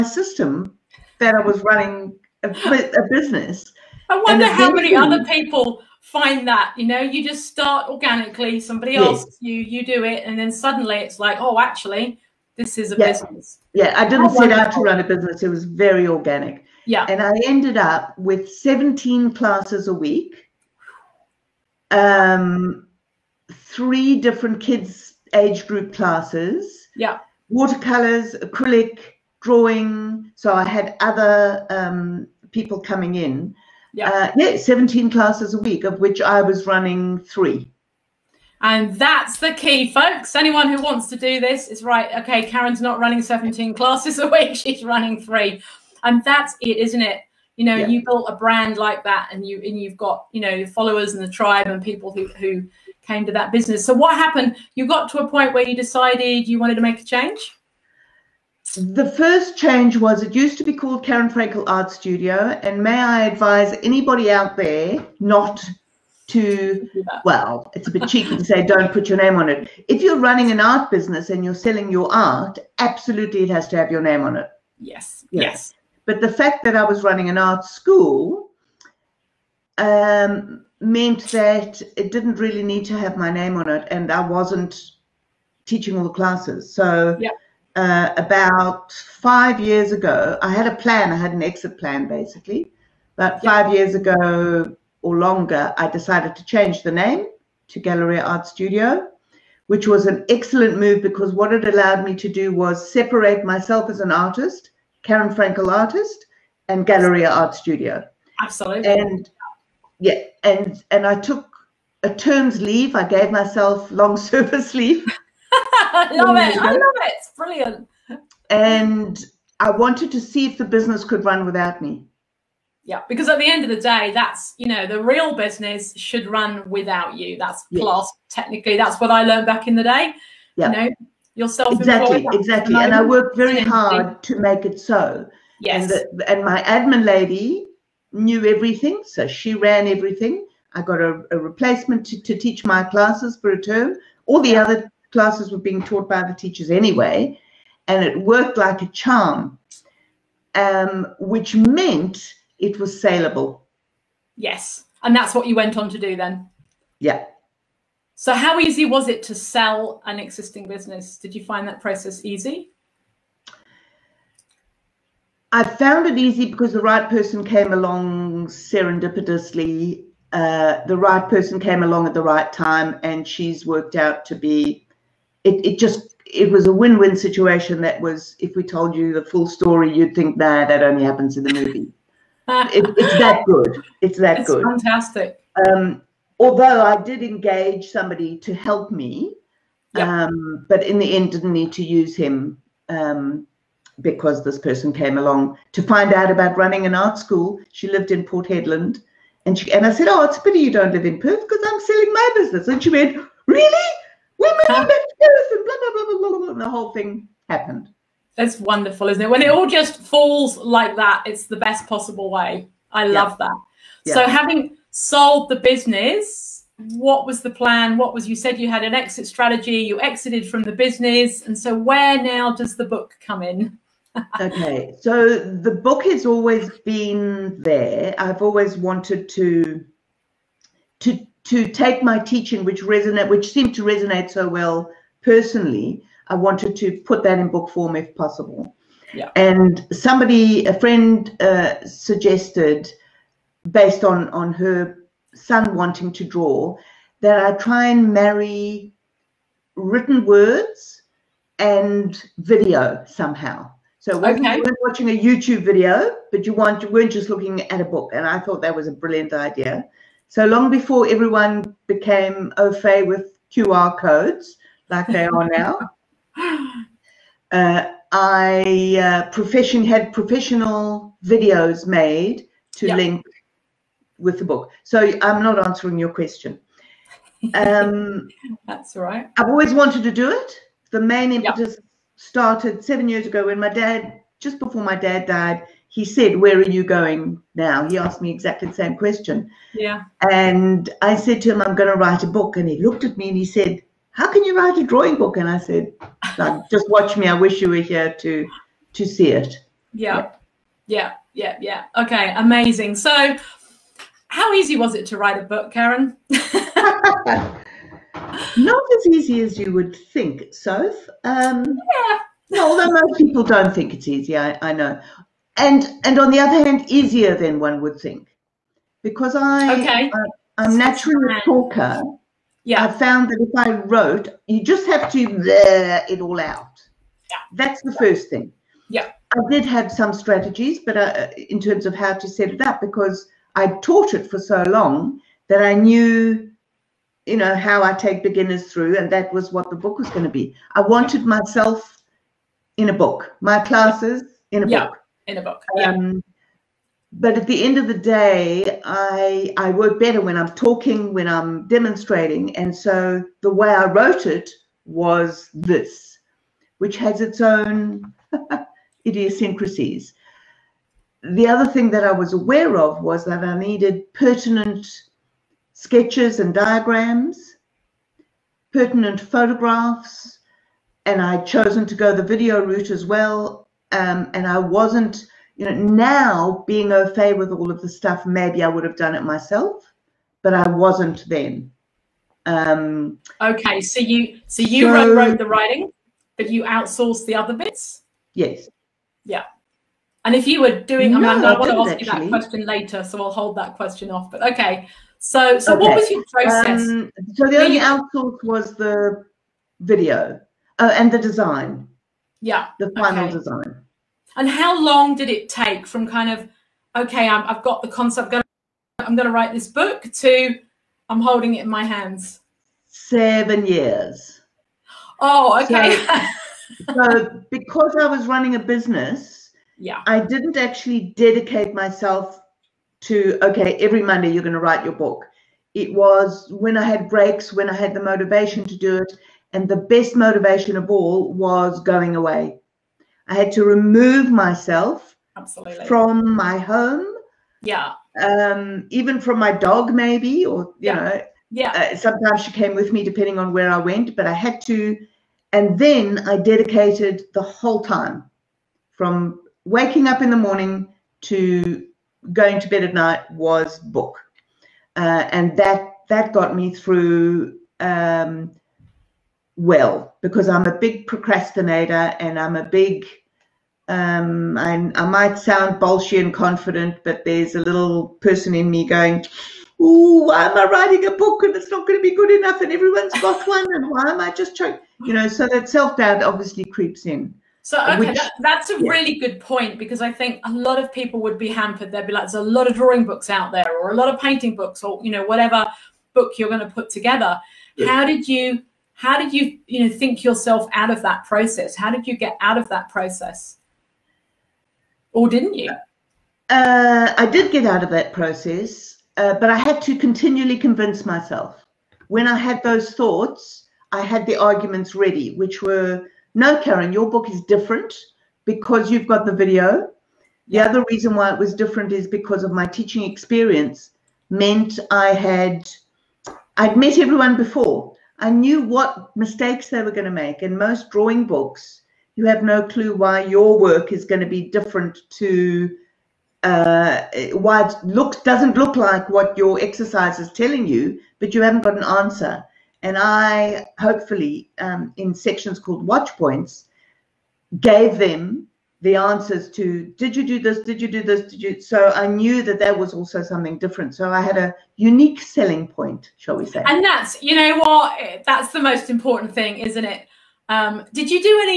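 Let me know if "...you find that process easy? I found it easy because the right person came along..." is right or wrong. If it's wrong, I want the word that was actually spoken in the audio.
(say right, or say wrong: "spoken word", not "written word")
right.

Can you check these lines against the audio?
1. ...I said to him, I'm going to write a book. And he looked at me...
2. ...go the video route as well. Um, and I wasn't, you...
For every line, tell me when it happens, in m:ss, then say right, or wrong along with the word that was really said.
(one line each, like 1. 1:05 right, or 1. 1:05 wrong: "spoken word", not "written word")
1. 4:51 right
2. 6:11 right.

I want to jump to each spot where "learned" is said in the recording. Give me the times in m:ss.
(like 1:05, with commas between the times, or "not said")
2:09.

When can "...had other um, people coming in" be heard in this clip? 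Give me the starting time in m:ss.
0:30.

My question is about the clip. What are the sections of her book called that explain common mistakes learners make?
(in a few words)
Watch points.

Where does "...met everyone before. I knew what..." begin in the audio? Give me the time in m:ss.
8:36.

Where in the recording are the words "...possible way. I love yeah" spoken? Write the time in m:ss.
3:31.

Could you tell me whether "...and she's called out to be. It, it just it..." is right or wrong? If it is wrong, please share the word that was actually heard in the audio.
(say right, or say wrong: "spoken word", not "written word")
wrong: "worked", not "called".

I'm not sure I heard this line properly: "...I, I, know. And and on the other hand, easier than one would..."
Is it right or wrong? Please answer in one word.
right.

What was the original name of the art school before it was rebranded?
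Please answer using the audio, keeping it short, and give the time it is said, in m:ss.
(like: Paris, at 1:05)
Karen Frankel Art Studio, at 1:01.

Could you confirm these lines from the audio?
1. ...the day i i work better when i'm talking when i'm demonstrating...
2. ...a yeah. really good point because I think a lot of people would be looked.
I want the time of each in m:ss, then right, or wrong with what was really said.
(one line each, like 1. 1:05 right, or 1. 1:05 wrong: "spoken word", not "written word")
1. 5:47 right
2. 7:58 wrong: "hampered", not "looked".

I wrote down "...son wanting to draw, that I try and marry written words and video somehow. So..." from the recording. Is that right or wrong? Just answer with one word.
right.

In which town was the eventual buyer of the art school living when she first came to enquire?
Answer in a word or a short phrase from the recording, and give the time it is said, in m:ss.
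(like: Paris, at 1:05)
Port Hedland, at 3:18.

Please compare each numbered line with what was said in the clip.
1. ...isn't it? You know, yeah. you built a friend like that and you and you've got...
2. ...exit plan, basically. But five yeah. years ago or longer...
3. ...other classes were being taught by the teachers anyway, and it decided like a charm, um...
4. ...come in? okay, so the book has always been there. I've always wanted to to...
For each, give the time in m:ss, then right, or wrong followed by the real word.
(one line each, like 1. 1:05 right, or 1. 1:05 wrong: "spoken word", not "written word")
1. 0:46 wrong: "brand", not "friend"
2. 1:31 right
3. 2:24 wrong: "worked", not "decided"
4. 3:43 right.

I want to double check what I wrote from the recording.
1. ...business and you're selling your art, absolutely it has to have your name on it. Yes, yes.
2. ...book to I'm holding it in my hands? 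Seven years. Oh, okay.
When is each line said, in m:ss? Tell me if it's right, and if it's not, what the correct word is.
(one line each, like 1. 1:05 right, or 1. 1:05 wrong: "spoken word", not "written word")
1. 1:10 right
2. 6:49 right.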